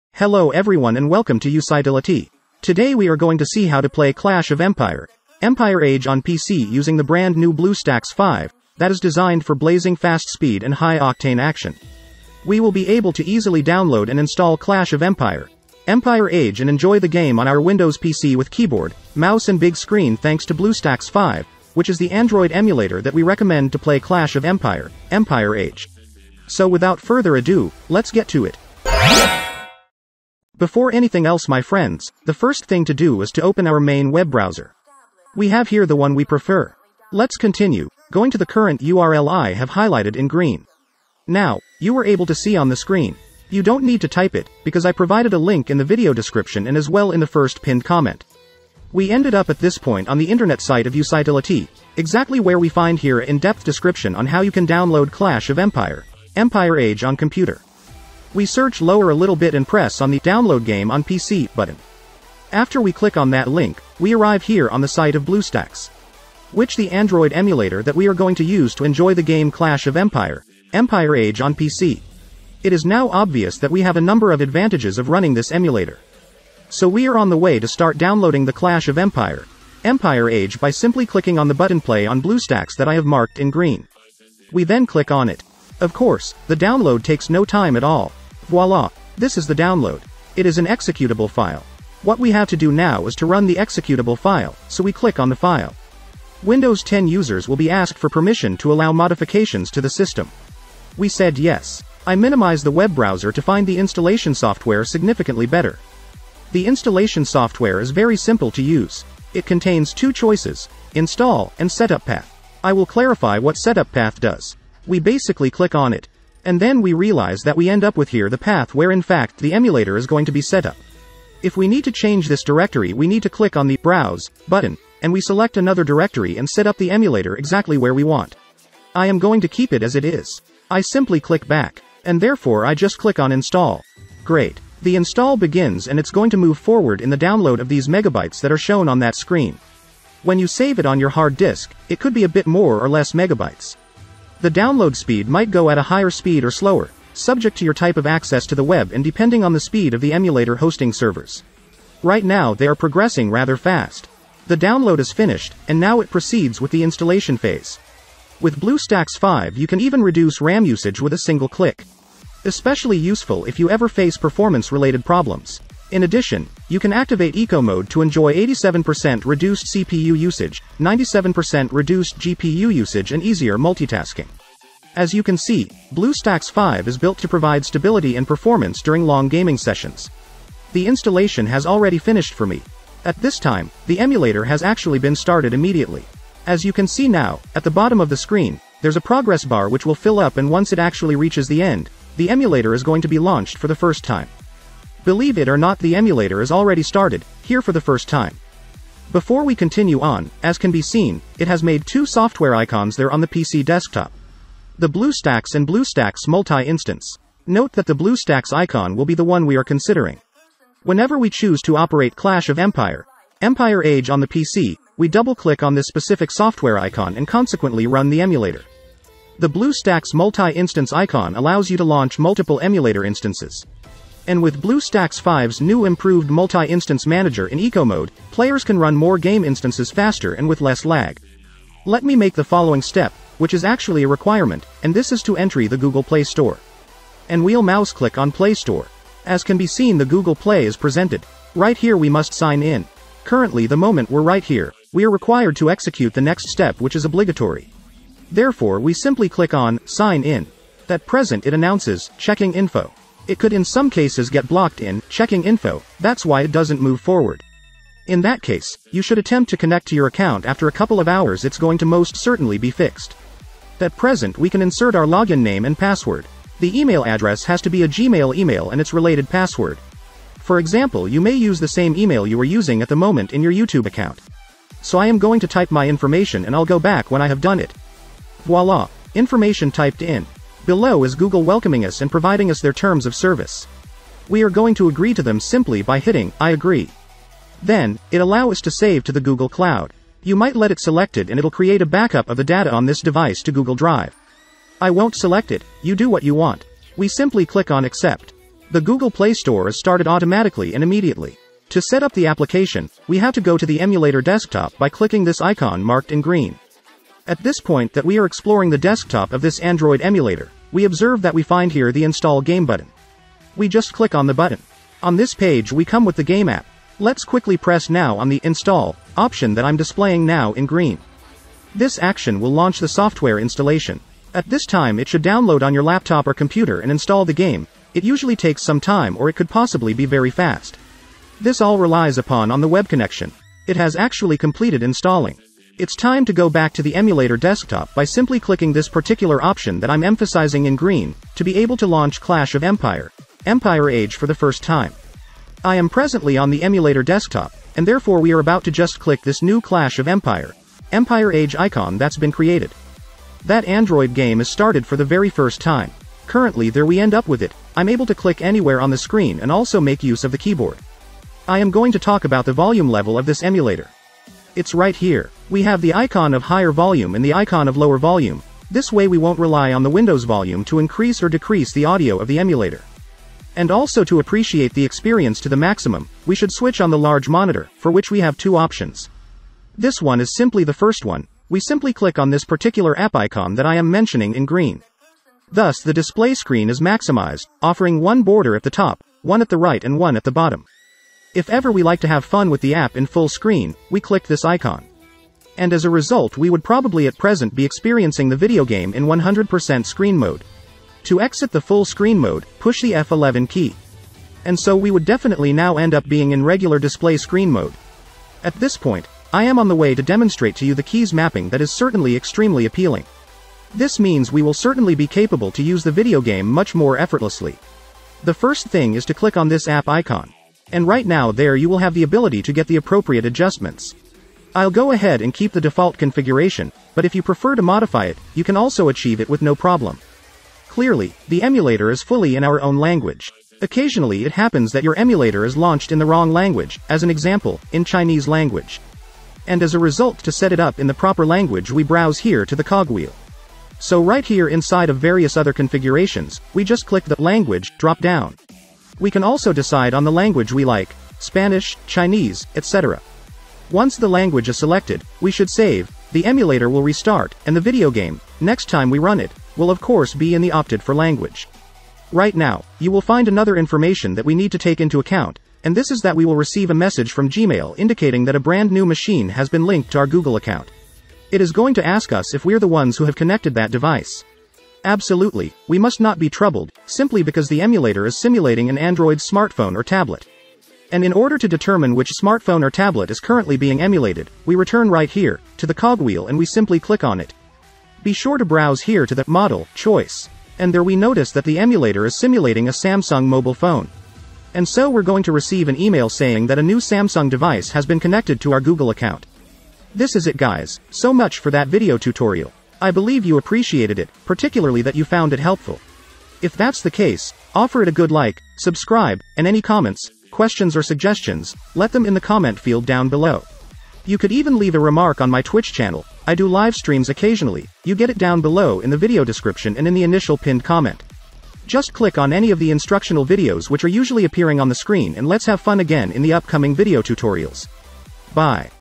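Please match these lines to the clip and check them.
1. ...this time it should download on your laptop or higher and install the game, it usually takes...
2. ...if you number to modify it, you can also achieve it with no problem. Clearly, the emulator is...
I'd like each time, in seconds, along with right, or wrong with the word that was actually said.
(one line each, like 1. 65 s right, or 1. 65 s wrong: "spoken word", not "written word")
1. 324 s wrong: "computer", not "higher"
2. 427 s wrong: "prefer", not "number".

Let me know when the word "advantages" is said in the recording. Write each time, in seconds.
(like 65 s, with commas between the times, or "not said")
74 s.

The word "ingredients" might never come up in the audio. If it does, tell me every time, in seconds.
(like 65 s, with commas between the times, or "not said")
not said.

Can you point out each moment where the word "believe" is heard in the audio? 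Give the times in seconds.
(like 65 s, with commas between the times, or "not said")
195 s, 502 s.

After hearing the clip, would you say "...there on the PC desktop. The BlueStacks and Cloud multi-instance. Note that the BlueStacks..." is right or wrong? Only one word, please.
wrong.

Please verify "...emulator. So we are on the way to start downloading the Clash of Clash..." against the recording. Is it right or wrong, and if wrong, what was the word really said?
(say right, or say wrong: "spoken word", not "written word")
wrong: "Empire", not "Clash".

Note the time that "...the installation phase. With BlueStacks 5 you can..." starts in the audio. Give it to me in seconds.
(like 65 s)
156 s.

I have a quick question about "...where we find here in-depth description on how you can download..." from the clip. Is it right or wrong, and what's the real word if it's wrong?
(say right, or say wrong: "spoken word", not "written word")
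right.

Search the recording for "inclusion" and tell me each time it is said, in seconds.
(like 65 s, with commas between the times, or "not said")
not said.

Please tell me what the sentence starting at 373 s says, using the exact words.
And also to appreciate the experience to the maximum, we should switch on the large monitor, for which we have two options.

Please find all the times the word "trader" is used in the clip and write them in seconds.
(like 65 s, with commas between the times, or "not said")
not said.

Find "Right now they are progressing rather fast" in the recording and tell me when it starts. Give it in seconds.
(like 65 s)
152 s.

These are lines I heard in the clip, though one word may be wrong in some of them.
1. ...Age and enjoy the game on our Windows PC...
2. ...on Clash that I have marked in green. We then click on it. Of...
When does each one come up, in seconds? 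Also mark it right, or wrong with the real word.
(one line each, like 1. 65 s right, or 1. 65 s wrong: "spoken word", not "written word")
1. 16 s right
2. 82 s wrong: "BlueStacks", not "Clash".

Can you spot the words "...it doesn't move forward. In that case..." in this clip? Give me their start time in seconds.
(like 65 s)
256 s.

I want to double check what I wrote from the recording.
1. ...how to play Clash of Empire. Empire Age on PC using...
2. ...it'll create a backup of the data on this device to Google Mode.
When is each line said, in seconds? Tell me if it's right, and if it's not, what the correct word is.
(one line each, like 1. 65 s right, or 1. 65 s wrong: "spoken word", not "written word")
1. 3 s right
2. 291 s wrong: "Drive", not "Mode".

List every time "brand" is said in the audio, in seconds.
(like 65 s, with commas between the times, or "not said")
7 s, 468 s.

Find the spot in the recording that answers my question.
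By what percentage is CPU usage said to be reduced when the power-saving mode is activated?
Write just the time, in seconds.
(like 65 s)
168 s.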